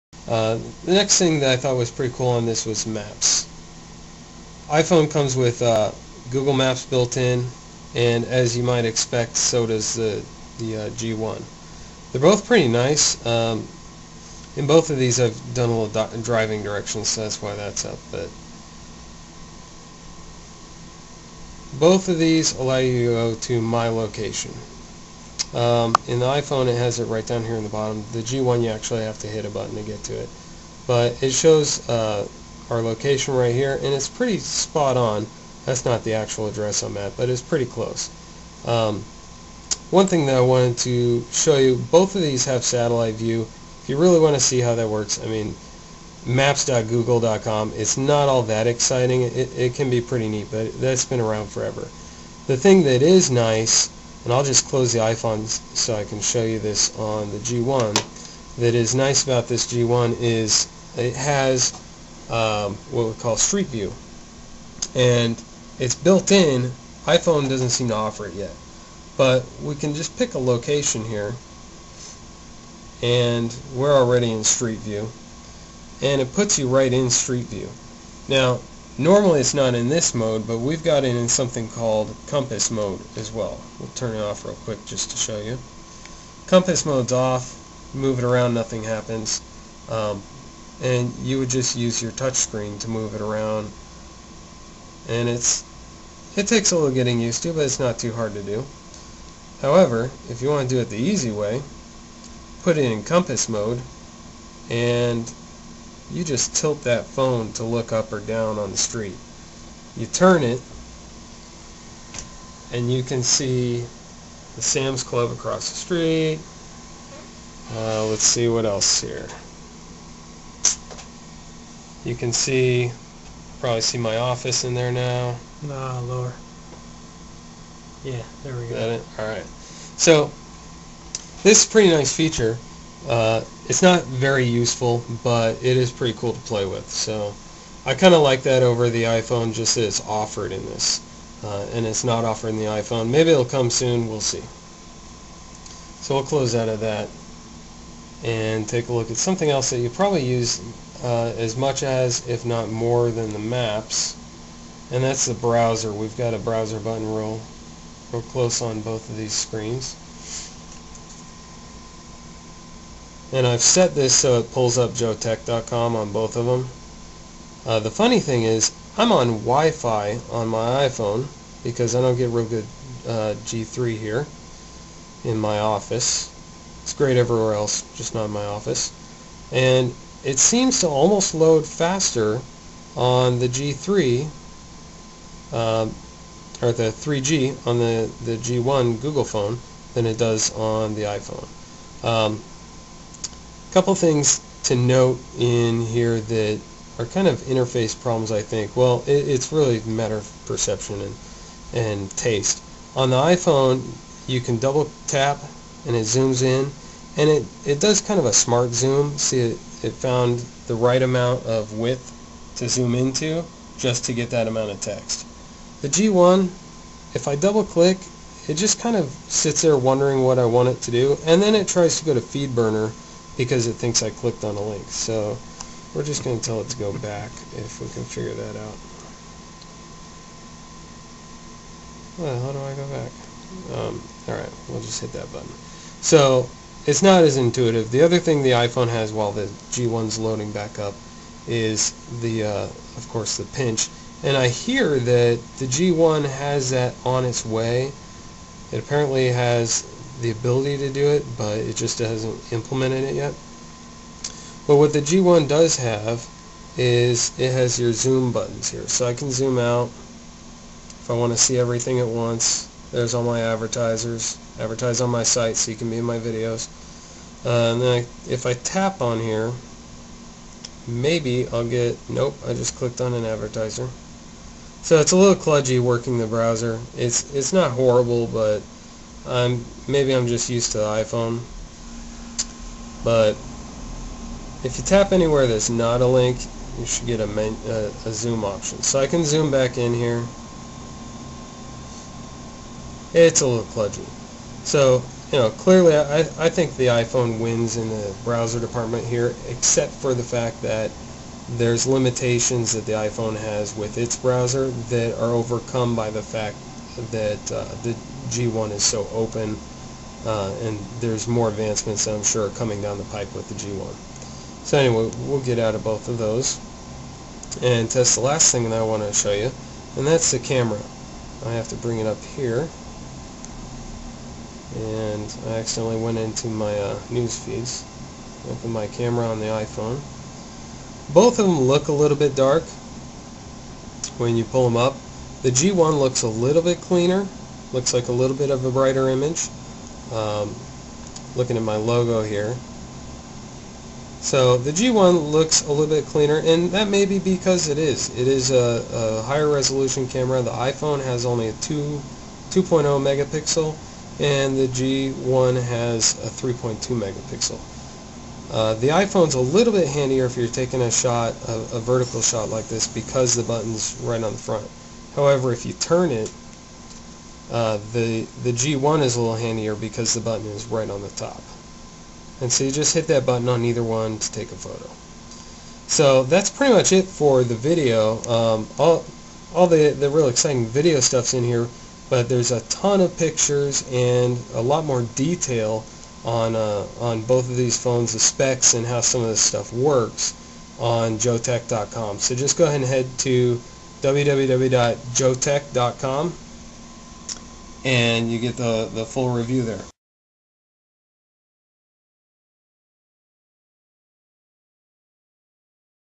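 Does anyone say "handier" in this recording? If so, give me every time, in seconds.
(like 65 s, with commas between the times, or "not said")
359 s, 369 s.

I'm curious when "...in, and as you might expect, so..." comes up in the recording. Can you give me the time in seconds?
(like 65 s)
7 s.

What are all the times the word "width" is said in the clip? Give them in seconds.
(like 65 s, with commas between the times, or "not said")
211 s.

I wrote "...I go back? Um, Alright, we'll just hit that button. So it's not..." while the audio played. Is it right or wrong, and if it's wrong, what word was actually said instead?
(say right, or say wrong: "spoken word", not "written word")
right.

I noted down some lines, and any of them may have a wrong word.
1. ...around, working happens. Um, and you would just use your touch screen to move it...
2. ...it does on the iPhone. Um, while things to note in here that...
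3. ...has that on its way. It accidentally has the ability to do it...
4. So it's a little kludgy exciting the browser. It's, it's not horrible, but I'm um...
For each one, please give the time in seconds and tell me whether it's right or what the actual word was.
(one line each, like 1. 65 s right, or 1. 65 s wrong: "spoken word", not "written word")
1. 88 s wrong: "nothing", not "working"
2. 190 s wrong: "couple", not "while"
3. 246 s wrong: "apparently", not "accidentally"
4. 274 s wrong: "working", not "exciting".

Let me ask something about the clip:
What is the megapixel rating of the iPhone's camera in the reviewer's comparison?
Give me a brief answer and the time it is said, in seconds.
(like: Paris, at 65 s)
2.0 megapixels, at 351 s.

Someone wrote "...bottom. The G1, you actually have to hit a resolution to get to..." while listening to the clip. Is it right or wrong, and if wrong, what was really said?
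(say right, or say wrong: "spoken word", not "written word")
wrong: "button", not "resolution".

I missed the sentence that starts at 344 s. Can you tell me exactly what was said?
So the G1 looks a little bit cleaner, and that may be because it is.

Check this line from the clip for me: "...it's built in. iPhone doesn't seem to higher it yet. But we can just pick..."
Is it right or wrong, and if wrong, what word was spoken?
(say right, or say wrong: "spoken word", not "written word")
wrong: "offer", not "higher".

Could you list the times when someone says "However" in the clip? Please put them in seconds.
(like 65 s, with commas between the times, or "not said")
99 s, 365 s.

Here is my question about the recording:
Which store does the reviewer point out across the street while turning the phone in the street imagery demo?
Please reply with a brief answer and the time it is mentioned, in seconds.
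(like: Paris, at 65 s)
Sam's Club, at 114 s.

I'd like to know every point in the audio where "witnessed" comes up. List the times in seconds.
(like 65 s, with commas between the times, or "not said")
not said.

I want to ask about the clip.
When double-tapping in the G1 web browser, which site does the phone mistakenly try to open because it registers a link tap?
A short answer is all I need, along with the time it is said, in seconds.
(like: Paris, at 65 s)
FeedBurner, at 222 s.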